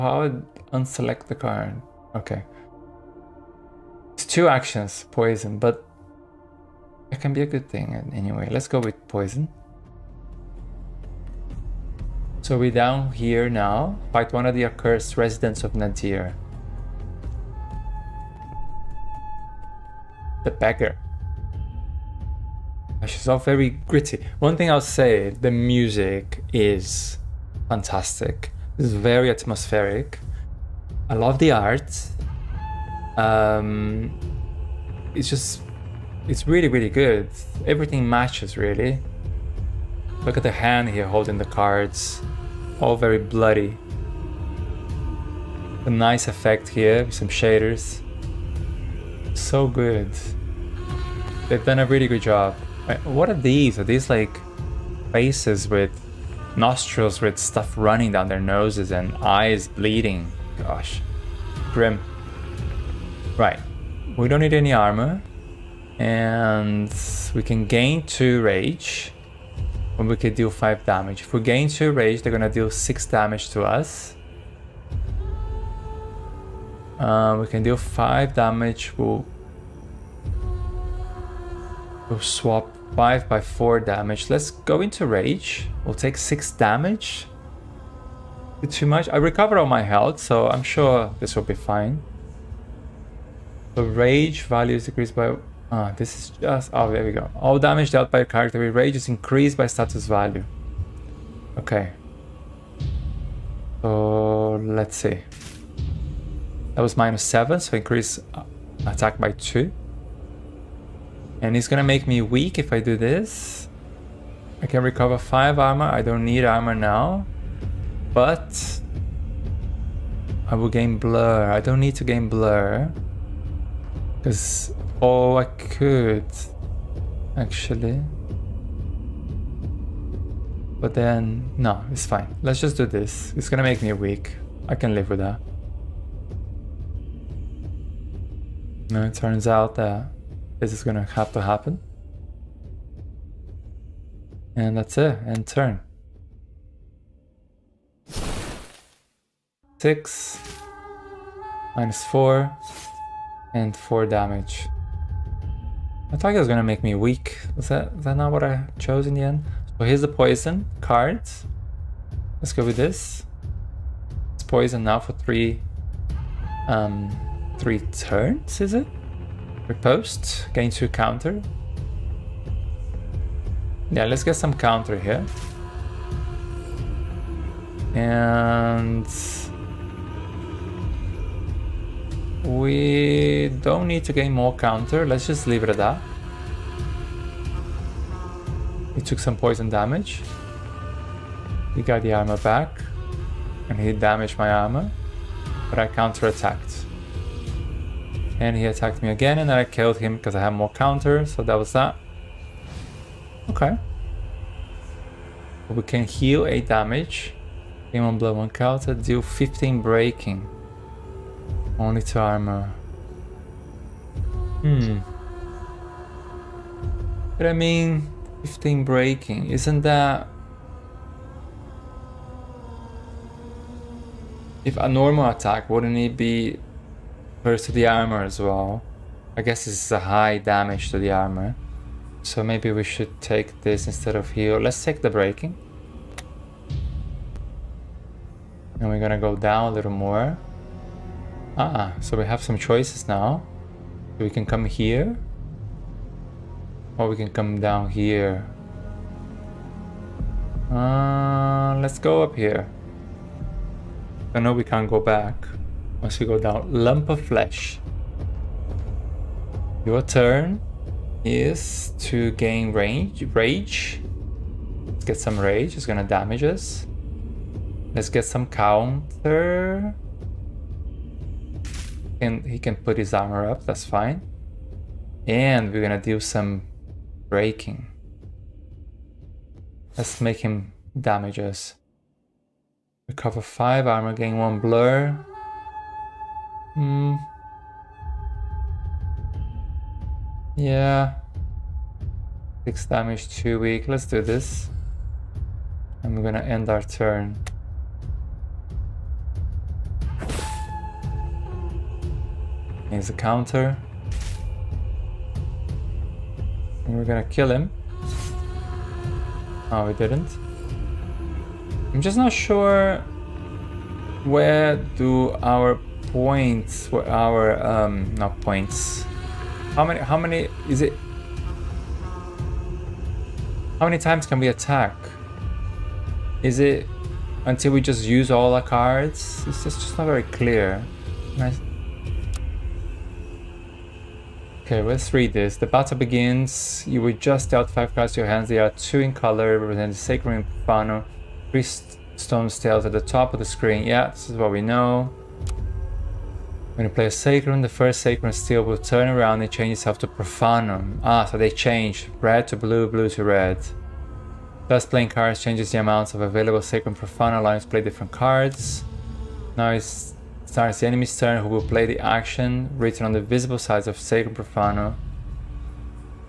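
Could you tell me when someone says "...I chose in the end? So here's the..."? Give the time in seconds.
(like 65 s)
158 s.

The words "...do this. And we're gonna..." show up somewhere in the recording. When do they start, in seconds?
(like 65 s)
294 s.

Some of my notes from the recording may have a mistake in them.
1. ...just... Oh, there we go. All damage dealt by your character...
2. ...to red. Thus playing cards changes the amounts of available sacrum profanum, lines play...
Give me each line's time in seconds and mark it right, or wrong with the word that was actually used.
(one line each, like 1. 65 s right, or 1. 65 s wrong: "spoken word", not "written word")
1. 96 s right
2. 353 s right.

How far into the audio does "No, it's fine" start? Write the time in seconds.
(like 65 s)
131 s.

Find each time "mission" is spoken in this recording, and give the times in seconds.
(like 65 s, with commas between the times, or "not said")
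not said.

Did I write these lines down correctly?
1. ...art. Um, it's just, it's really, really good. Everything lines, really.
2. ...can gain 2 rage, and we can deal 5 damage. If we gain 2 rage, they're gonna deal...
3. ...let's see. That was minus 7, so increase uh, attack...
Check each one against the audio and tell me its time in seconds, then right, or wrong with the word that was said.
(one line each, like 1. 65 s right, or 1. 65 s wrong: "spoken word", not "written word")
1. 31 s wrong: "matches", not "lines"
2. 67 s right
3. 104 s right.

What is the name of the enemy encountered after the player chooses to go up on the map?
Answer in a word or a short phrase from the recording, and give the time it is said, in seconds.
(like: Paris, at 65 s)
lump of flesh, at 256 s.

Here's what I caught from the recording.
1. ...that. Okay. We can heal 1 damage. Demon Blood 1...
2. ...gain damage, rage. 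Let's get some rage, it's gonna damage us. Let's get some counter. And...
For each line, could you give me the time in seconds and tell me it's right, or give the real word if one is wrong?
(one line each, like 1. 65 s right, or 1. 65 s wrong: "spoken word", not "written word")
1. 201 s wrong: "8", not "1"
2. 262 s wrong: "range", not "damage".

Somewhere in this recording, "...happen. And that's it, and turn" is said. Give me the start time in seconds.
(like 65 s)
141 s.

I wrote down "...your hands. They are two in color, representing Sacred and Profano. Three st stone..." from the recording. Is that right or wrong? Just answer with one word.
right.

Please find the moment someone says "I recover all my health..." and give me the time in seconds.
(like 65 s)
89 s.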